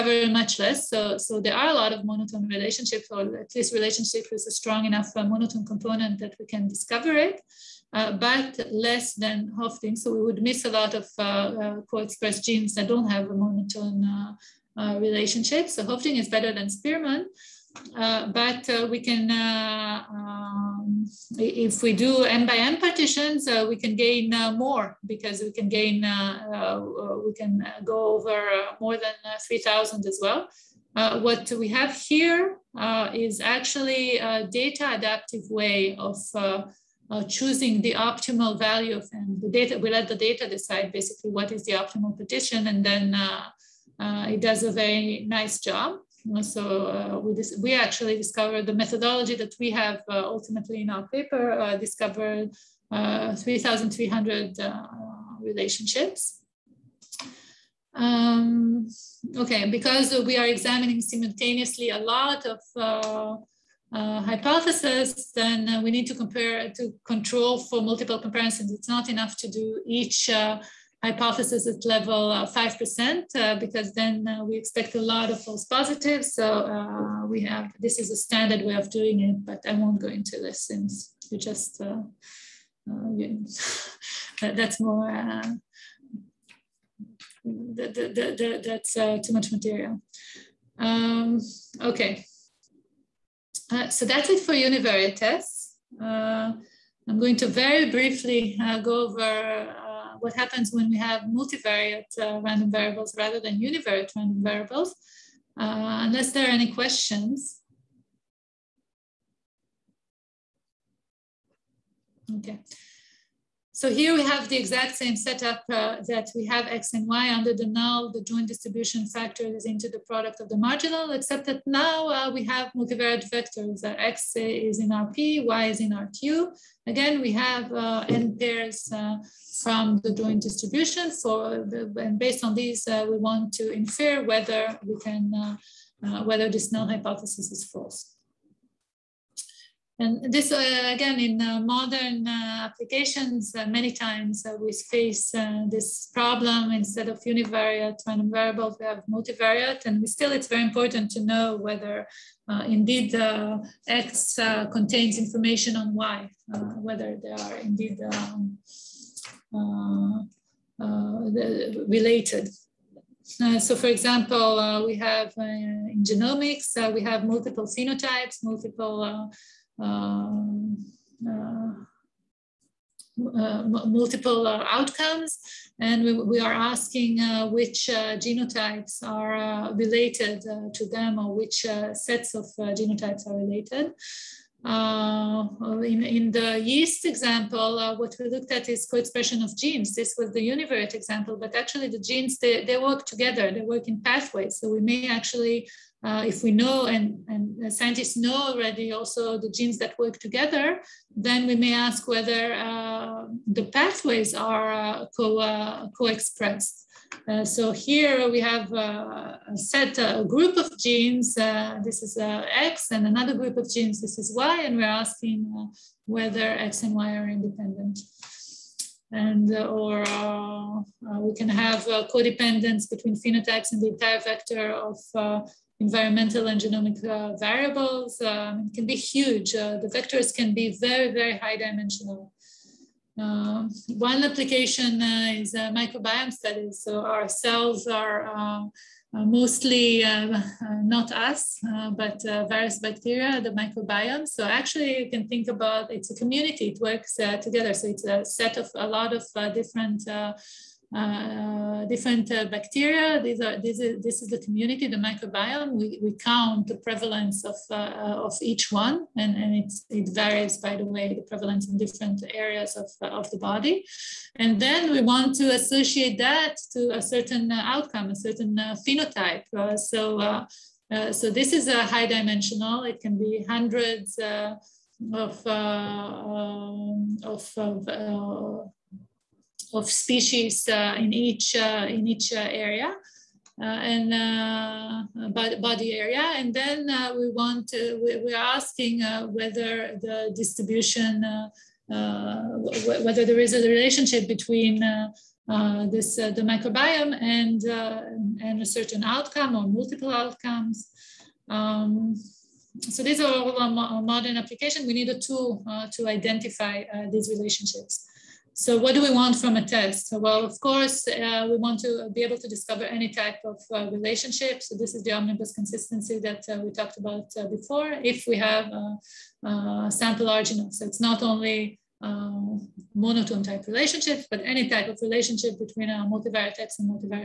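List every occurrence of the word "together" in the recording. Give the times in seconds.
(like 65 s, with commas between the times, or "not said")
193 s, 200 s, 247 s.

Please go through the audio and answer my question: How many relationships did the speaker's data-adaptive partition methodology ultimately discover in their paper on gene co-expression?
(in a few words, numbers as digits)
3,300.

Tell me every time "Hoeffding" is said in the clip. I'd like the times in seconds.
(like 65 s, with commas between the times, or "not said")
9 s, 15 s.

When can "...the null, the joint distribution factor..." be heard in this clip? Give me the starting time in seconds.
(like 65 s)
117 s.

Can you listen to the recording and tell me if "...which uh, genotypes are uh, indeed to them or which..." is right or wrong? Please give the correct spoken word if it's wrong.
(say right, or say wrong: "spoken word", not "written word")
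wrong: "related", not "indeed".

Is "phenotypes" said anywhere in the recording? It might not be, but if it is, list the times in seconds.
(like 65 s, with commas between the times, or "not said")
167 s, 223 s, 268 s.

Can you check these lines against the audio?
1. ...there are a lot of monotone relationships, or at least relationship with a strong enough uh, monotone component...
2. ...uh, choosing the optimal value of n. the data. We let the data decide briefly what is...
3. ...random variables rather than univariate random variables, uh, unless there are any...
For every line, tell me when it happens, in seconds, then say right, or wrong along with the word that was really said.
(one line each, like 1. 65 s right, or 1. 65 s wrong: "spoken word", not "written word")
1. 1 s right
2. 36 s wrong: "basically", not "briefly"
3. 102 s right.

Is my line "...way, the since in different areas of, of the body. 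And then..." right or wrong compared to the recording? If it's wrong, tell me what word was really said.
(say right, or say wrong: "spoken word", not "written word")
wrong: "prevalence", not "since".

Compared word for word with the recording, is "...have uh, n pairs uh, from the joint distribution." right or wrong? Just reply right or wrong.
right.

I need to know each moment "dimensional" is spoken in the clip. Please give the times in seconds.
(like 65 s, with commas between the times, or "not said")
231 s, 272 s.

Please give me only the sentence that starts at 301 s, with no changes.
Um, so these are all modern applications.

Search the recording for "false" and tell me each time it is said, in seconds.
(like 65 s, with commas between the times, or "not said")
75 s, 137 s.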